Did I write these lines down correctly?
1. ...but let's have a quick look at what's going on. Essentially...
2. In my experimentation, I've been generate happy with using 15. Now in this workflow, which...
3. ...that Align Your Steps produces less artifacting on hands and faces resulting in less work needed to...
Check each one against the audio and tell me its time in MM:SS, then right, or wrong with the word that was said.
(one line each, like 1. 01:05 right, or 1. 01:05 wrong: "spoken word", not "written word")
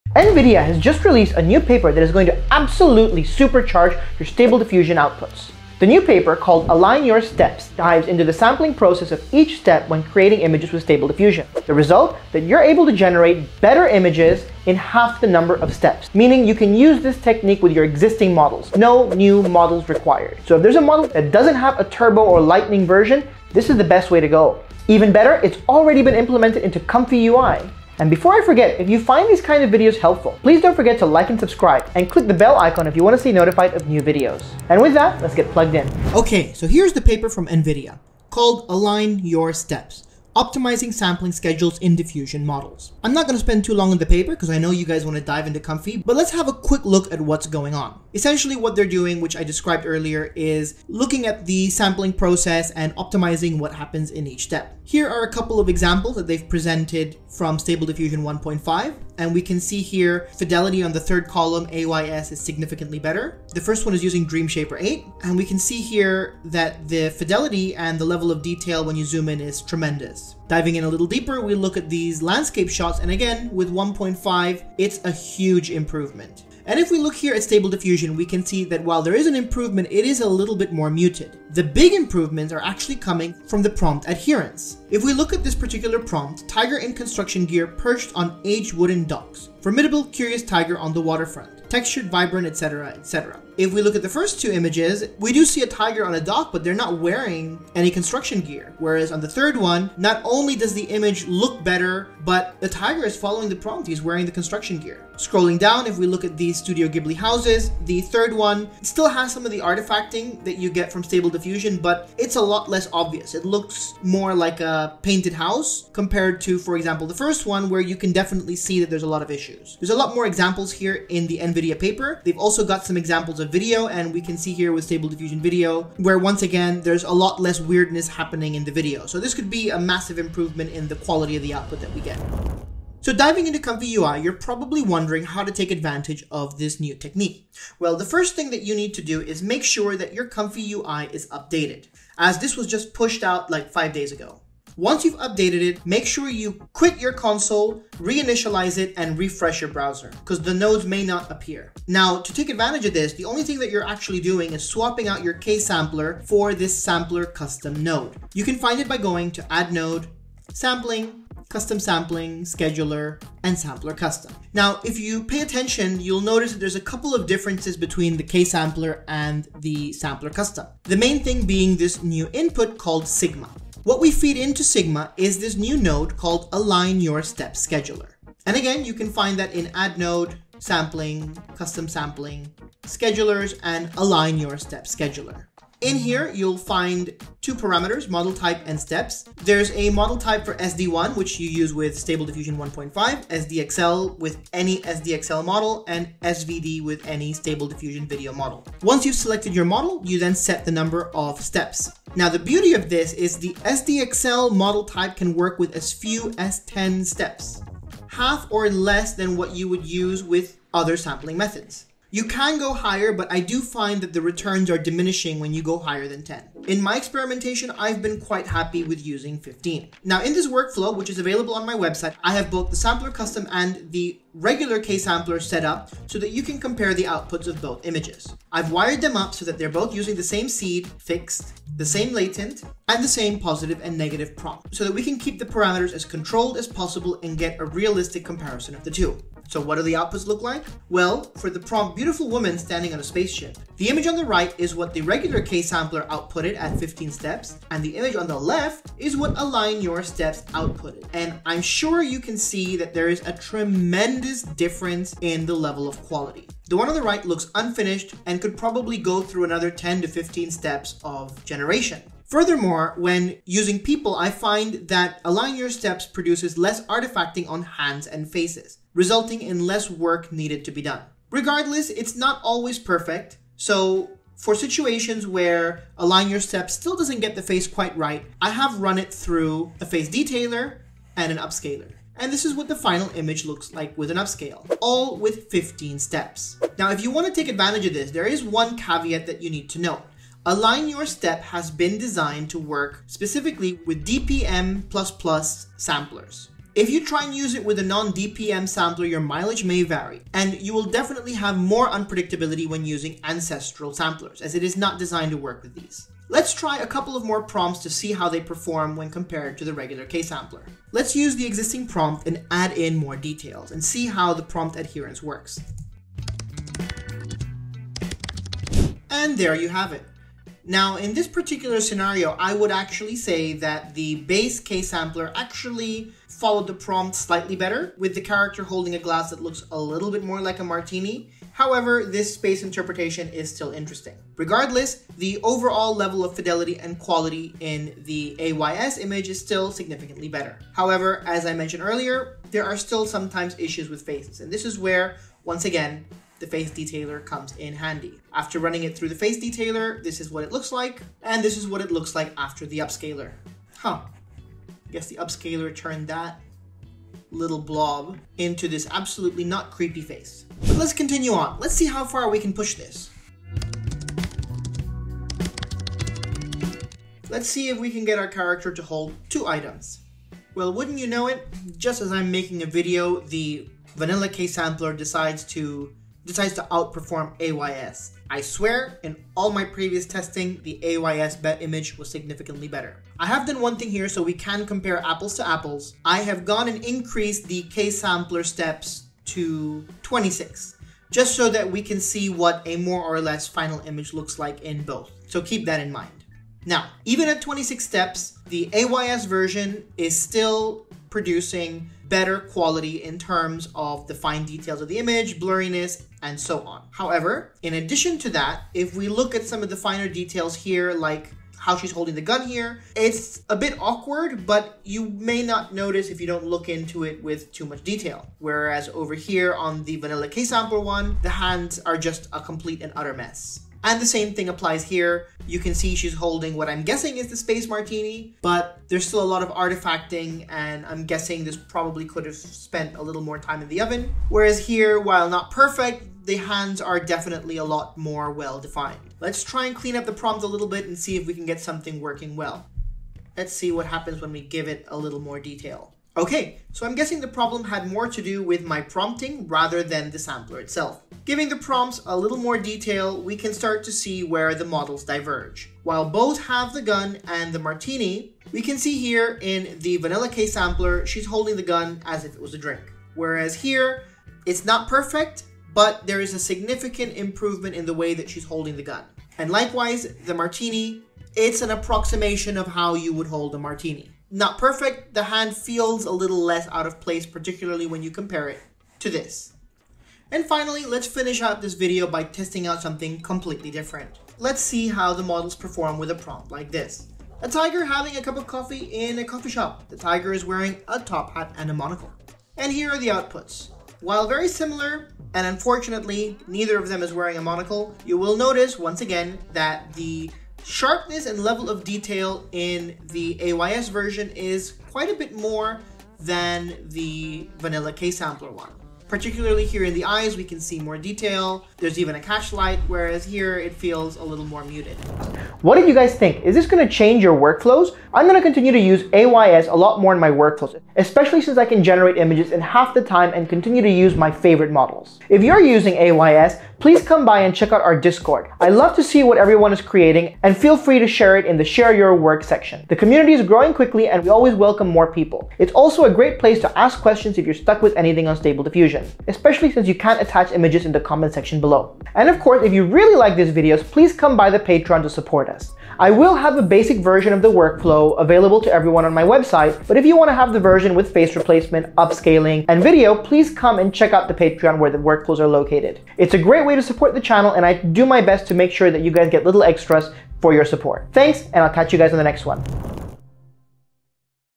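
1. 00:45 right
2. 03:36 wrong: "quite", not "generate"
3. 04:24 right.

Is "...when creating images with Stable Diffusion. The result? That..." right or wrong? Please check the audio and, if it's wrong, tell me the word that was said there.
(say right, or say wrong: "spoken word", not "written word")
right.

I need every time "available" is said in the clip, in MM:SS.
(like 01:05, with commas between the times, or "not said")
03:41, 09:08.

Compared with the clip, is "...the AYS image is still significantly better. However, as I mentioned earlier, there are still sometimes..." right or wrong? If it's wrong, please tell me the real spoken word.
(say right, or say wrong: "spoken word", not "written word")
right.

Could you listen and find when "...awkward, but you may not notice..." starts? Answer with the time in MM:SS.
06:53.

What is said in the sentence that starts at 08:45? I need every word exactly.
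If you're using AYS, please come by and check out our Discord.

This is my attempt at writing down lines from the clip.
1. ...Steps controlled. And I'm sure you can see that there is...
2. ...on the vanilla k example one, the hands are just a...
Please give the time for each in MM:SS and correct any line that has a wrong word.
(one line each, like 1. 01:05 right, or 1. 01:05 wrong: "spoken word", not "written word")
1. 04:10 wrong: "outputted", not "controlled"
2. 06:59 wrong: "sample", not "example".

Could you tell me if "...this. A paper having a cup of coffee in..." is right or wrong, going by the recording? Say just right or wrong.
wrong.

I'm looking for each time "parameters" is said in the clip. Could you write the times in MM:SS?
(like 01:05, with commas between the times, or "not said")
03:07, 03:55.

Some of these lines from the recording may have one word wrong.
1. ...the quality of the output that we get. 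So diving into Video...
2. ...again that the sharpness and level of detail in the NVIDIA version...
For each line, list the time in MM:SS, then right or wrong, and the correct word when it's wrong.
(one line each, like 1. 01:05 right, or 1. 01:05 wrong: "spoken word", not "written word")
1. 02:10 wrong: "ComfyUI", not "Video"
2. 08:19 wrong: "AYS", not "NVIDIA".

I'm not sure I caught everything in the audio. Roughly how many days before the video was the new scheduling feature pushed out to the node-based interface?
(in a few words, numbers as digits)
5.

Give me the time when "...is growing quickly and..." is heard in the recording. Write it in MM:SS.
08:53.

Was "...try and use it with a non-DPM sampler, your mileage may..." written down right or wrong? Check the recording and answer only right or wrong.
right.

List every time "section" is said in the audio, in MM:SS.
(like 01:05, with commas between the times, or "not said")
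08:52, 09:01.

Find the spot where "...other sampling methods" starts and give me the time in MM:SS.
03:30.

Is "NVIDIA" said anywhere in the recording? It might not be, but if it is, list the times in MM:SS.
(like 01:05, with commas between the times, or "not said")
00:00, 00:37, 02:01.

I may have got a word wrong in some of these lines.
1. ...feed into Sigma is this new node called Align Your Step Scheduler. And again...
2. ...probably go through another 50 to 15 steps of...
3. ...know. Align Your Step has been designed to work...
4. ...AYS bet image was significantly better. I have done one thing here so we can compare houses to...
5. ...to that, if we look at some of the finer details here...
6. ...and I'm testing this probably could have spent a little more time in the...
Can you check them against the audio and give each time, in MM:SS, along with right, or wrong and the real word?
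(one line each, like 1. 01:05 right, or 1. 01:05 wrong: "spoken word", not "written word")
1. 02:54 right
2. 04:18 wrong: "10", not "50"
3. 04:49 right
4. 06:20 wrong: "apples", not "houses"
5. 06:48 right
6. 07:10 wrong: "guessing", not "testing".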